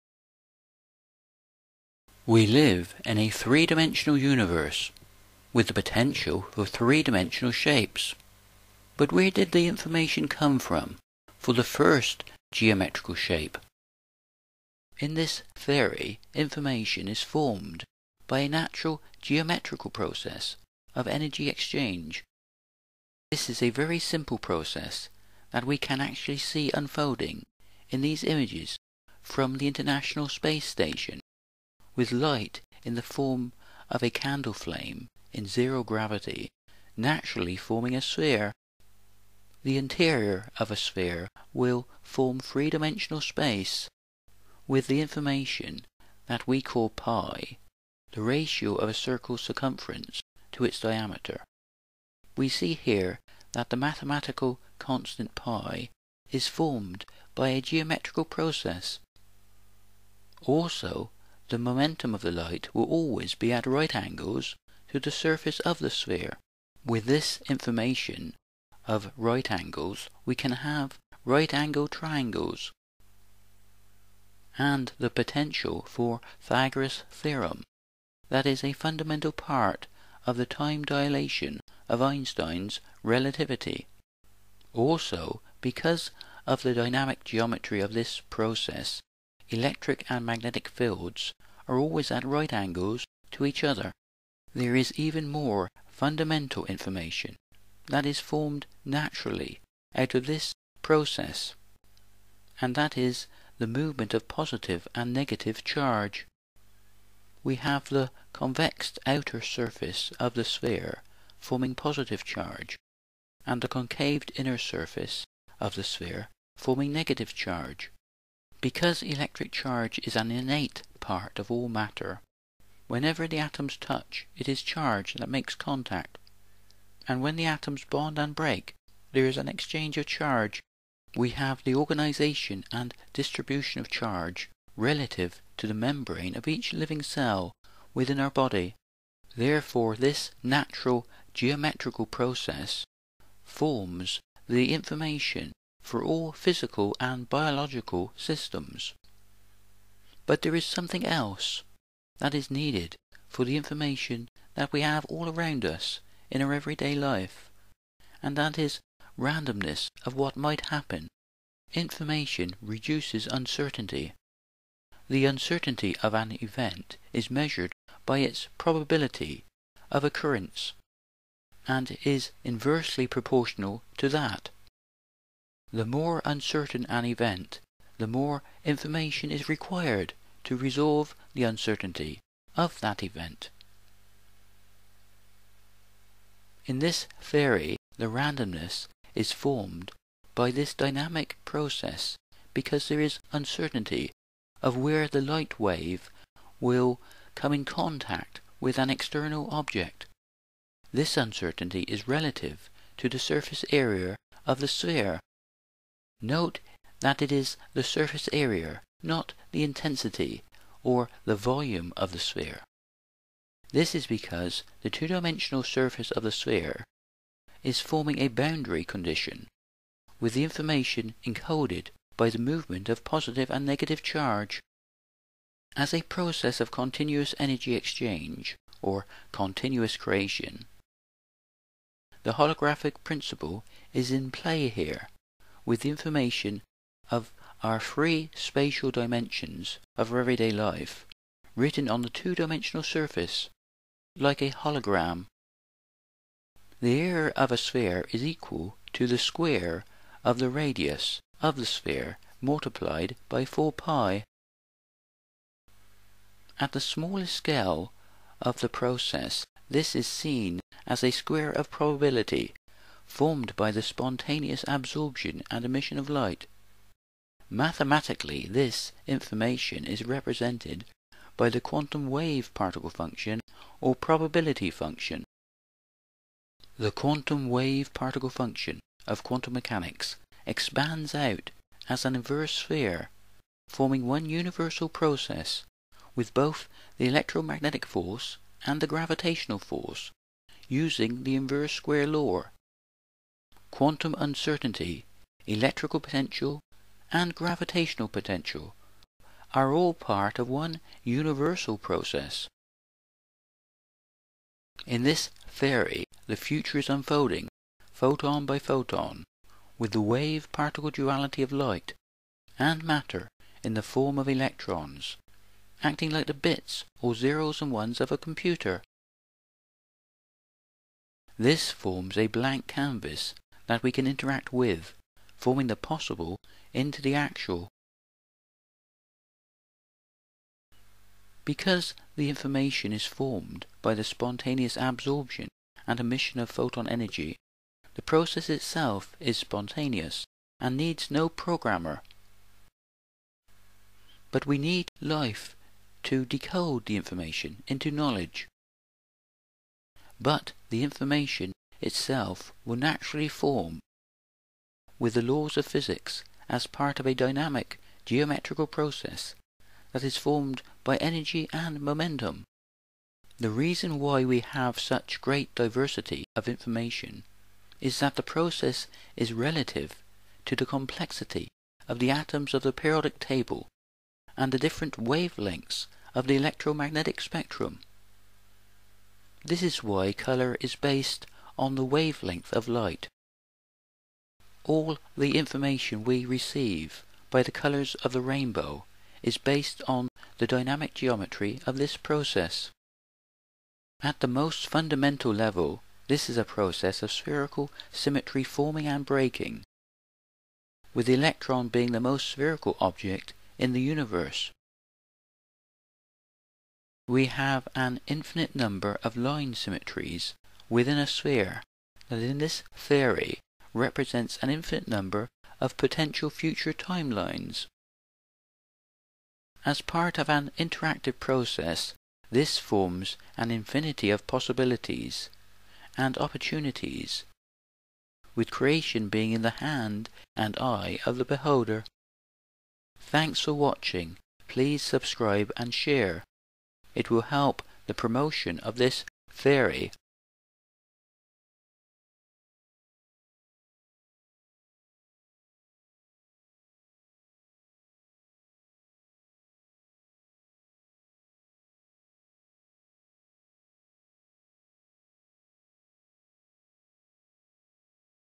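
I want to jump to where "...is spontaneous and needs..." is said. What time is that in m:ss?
5:39.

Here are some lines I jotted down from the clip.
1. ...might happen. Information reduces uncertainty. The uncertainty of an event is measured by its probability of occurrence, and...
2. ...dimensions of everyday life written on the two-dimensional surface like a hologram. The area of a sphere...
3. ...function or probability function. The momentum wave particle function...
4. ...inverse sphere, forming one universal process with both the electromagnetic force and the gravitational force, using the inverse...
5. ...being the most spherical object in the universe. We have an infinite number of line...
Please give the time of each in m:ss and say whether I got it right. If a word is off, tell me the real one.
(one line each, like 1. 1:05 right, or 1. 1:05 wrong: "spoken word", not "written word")
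1. 2:40 right
2. 3:58 right
3. 4:32 wrong: "quantum", not "momentum"
4. 4:42 right
5. 6:41 right.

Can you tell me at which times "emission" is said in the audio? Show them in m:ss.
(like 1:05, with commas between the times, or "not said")
4:25, 5:35.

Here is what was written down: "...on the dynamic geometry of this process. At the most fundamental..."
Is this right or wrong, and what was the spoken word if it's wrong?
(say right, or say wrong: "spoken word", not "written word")
right.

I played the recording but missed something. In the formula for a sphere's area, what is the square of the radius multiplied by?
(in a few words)
4 pi.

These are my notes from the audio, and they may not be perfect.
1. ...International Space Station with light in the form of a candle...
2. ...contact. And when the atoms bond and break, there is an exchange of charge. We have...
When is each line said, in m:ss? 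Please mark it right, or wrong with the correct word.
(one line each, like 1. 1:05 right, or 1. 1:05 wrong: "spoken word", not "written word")
1. 0:29 right
2. 2:05 right.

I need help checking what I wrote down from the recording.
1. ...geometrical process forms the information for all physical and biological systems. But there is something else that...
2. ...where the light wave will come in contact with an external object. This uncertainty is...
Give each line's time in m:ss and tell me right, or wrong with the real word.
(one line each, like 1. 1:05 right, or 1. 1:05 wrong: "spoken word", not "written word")
1. 2:21 right
2. 3:14 right.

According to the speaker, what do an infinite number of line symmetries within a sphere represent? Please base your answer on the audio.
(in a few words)
potential future timelines.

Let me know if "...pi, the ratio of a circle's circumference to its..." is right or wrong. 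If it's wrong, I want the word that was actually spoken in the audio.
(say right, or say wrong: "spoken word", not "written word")
right.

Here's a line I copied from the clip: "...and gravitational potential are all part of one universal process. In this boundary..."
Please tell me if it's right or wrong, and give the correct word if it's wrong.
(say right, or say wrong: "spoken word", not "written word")
wrong: "theory", not "boundary".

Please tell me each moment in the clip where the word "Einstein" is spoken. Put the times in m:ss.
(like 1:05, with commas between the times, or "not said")
1:22.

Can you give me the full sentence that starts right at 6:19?
This is why colour is based on the wavelength of light.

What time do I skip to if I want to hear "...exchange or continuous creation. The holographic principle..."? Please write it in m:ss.
3:47.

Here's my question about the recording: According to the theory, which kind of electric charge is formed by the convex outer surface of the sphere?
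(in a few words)
positive charge.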